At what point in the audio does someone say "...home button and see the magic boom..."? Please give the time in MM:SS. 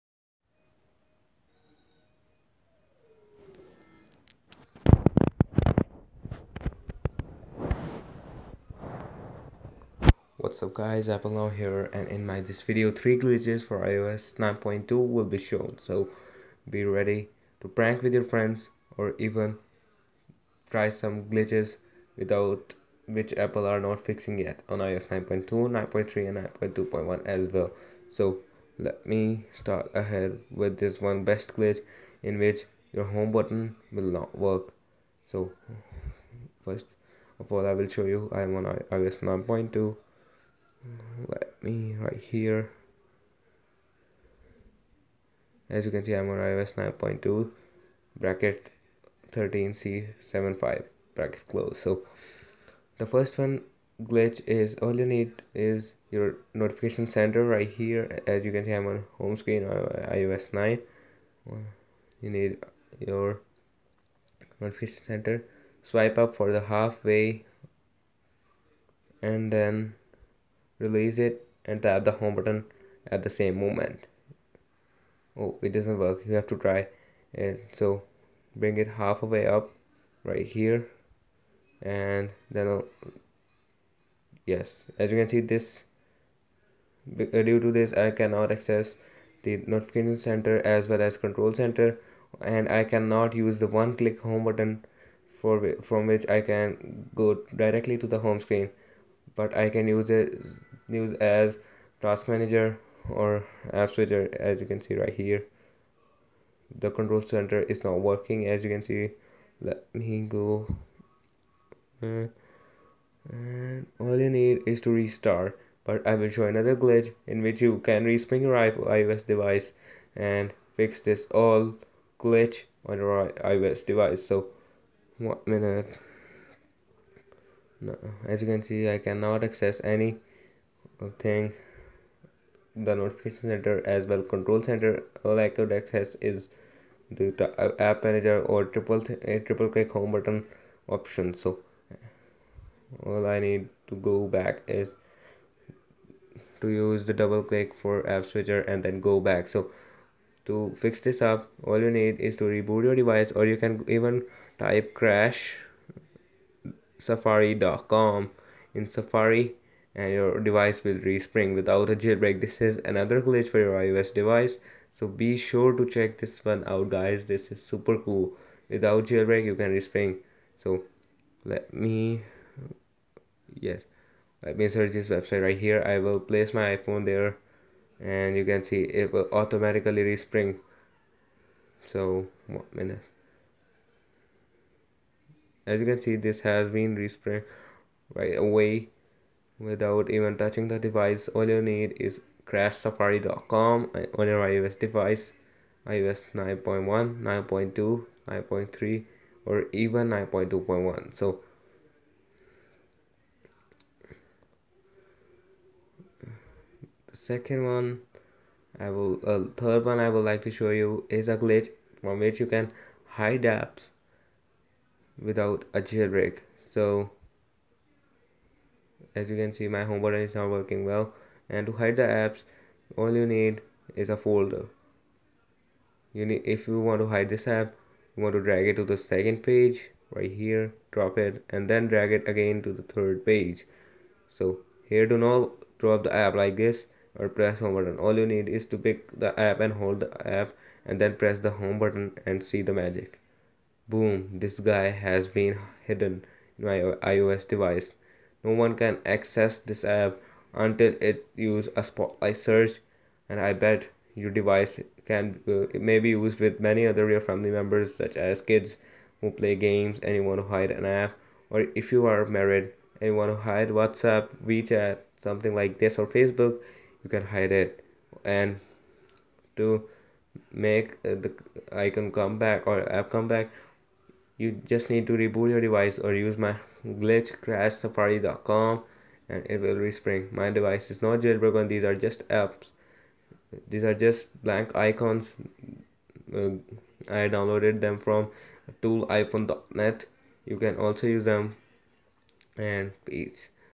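04:01.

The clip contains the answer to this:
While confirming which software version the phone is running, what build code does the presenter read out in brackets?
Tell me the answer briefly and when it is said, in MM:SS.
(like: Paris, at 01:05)
13C75, at 00:49.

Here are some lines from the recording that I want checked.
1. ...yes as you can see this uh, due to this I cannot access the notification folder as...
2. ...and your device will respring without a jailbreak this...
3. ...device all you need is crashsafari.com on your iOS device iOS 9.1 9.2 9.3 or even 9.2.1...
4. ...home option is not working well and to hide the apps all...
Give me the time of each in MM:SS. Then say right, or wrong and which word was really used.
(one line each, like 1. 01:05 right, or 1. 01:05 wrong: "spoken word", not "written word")
1. 01:24 wrong: "center", not "folder"
2. 02:39 right
3. 03:10 right
4. 03:39 wrong: "button", not "option".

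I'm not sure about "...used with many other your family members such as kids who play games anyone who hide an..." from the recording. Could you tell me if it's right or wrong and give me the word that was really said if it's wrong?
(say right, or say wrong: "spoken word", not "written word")
right.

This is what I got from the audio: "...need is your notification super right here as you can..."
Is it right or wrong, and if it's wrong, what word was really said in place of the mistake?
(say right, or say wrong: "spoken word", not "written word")
wrong: "center", not "super".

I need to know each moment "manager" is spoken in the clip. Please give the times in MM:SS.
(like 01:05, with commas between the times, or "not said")
01:42, 02:18.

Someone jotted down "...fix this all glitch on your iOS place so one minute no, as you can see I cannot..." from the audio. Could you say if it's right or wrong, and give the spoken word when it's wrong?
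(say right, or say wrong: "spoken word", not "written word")
wrong: "device", not "place".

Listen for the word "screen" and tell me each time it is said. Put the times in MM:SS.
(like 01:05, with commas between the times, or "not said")
00:59, 01:38.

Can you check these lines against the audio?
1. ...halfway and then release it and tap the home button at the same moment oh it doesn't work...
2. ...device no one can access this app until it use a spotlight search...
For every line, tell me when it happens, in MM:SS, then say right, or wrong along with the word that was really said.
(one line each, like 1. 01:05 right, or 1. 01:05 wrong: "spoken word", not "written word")
1. 01:06 right
2. 04:07 right.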